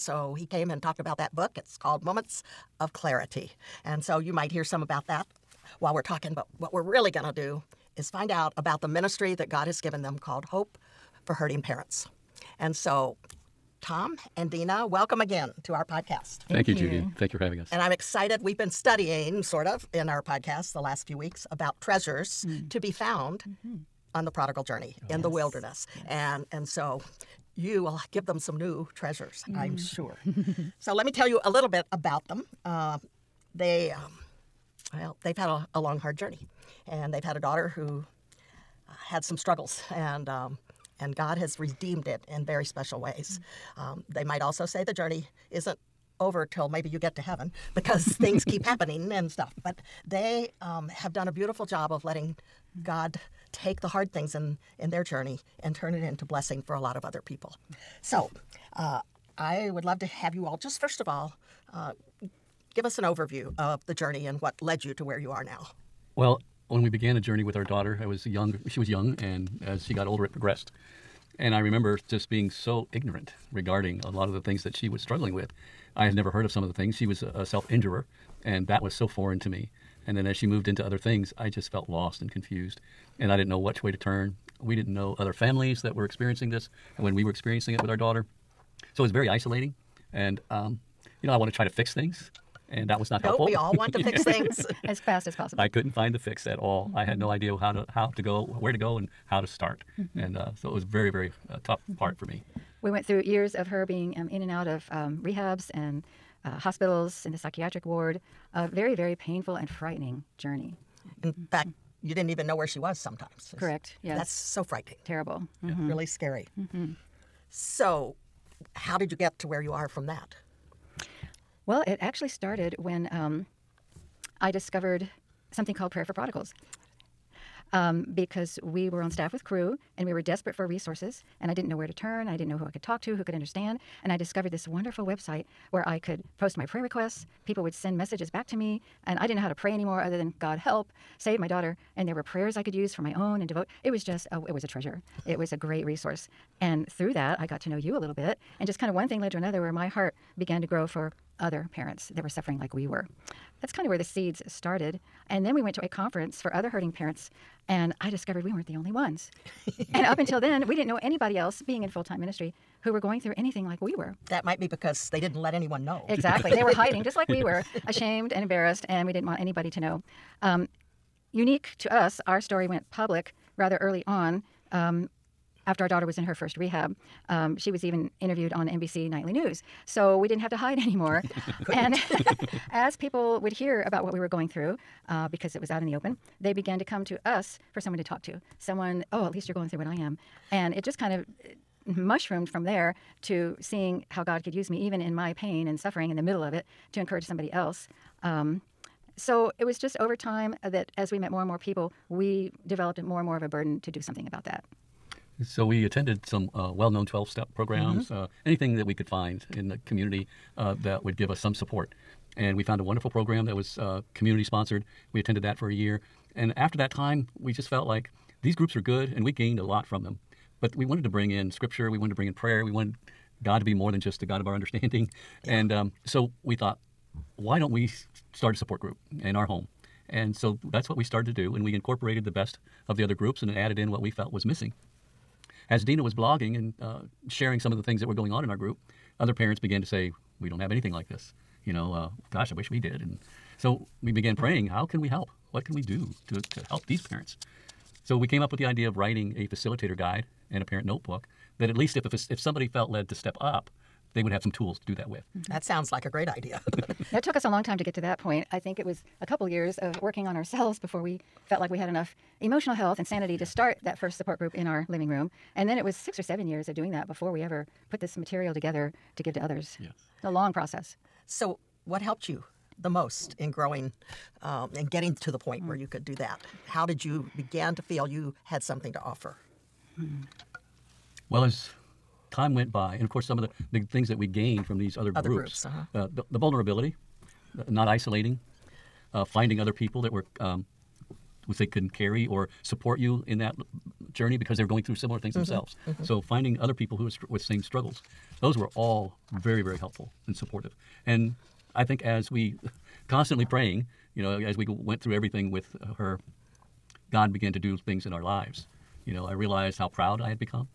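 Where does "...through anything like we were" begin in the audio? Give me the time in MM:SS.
02:43.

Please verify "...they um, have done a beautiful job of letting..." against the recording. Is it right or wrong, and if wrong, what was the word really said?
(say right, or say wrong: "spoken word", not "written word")
right.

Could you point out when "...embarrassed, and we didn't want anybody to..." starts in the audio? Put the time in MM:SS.
02:48.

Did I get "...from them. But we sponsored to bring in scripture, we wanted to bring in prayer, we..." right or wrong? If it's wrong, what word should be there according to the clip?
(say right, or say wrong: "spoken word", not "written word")
wrong: "wanted", not "sponsored".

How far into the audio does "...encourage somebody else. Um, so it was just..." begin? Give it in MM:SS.
03:16.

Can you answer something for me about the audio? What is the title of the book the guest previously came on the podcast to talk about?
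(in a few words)
Moments of Clarity.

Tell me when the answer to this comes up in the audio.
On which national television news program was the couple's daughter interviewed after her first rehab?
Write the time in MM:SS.
02:58.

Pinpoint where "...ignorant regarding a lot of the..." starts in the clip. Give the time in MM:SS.
01:12.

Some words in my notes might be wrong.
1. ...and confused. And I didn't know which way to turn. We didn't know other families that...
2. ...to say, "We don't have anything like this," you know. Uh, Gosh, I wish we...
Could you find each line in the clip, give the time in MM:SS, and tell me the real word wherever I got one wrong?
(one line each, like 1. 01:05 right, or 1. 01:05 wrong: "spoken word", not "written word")
1. 01:22 right
2. 03:59 right.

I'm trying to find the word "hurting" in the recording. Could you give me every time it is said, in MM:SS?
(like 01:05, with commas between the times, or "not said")
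00:11, 02:36.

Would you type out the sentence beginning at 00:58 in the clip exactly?
So, uh, I would love to have you all just first of all.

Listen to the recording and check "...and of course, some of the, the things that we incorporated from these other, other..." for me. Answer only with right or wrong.
wrong.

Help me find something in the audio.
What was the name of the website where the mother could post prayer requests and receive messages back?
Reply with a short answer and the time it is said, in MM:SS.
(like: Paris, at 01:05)
Prayer for Prodigals, at 02:05.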